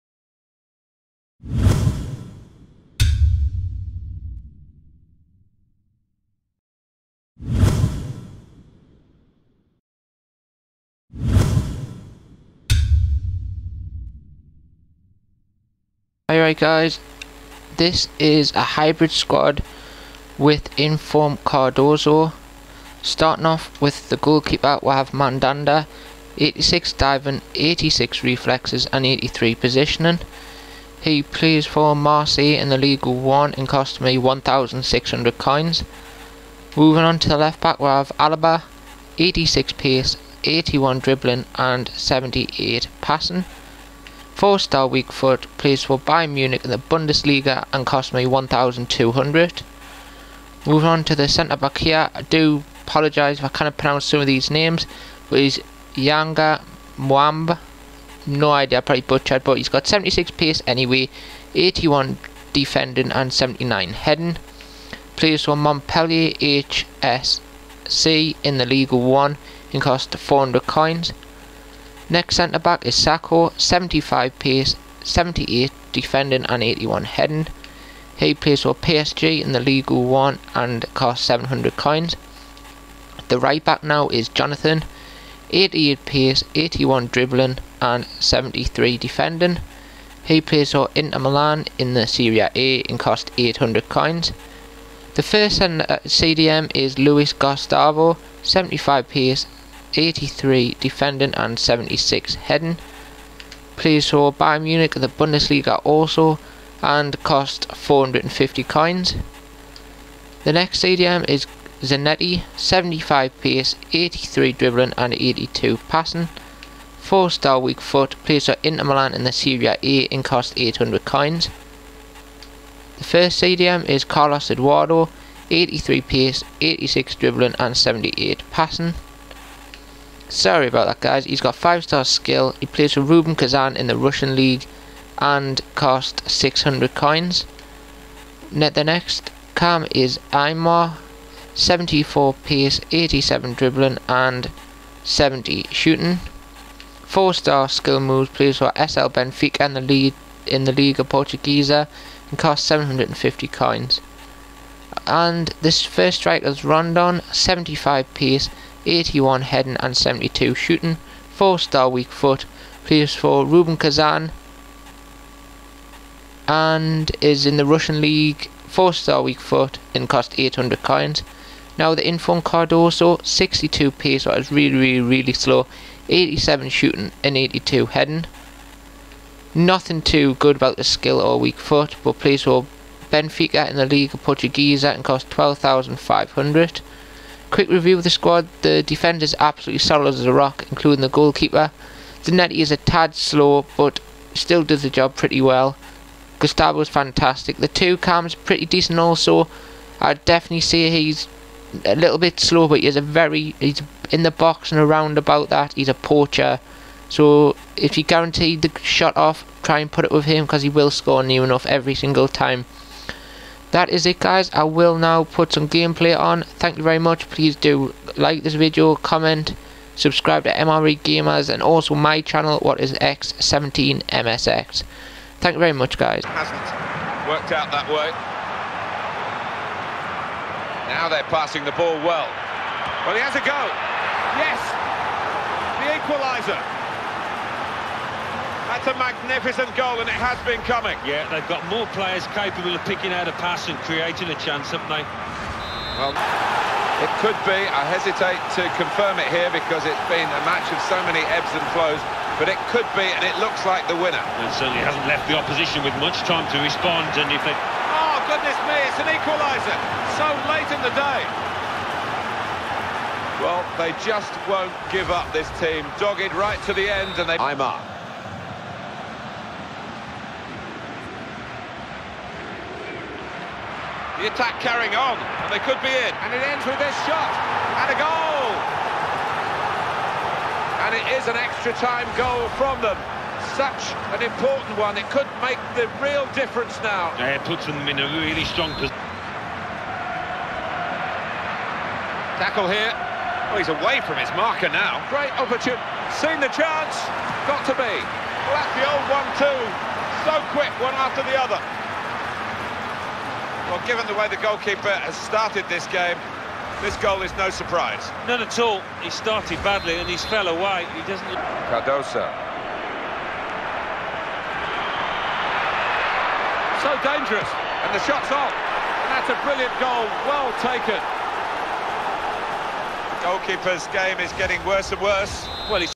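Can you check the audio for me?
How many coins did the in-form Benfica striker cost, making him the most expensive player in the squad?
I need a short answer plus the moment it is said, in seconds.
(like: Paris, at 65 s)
12,500, at 185 s.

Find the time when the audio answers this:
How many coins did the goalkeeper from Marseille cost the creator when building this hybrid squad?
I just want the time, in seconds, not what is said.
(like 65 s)
34 s.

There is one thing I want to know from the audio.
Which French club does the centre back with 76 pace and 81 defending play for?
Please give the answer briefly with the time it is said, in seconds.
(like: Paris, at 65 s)
Montpellier HSC, at 65 s.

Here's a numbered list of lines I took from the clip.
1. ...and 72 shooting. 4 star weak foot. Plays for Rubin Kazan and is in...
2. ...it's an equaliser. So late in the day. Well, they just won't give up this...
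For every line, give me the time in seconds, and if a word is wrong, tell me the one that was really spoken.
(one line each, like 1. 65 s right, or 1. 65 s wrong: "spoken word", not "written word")
1. 159 s right
2. 258 s right.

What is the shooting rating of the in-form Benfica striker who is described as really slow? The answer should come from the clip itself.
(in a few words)
87.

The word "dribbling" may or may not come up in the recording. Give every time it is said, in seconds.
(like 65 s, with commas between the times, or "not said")
40 s, 87 s, 114 s, 127 s, 143 s.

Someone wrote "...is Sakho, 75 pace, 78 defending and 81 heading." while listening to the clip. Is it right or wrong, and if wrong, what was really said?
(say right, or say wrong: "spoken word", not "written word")
right.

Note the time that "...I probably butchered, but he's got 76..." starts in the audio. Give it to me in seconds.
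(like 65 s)
58 s.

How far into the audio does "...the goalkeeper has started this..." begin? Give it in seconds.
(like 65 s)
304 s.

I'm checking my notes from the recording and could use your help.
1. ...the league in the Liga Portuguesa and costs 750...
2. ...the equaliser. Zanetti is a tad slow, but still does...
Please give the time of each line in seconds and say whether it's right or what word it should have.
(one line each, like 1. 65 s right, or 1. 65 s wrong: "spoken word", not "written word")
1. 149 s right
2. 191 s wrong: "goalkeeper", not "equaliser".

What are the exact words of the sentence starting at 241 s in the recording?
Yeah, they've got more players capable of picking out a pass and creating a chance, haven't they?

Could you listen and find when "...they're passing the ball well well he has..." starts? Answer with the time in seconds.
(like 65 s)
231 s.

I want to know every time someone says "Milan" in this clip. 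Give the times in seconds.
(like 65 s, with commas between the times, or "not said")
91 s, 118 s.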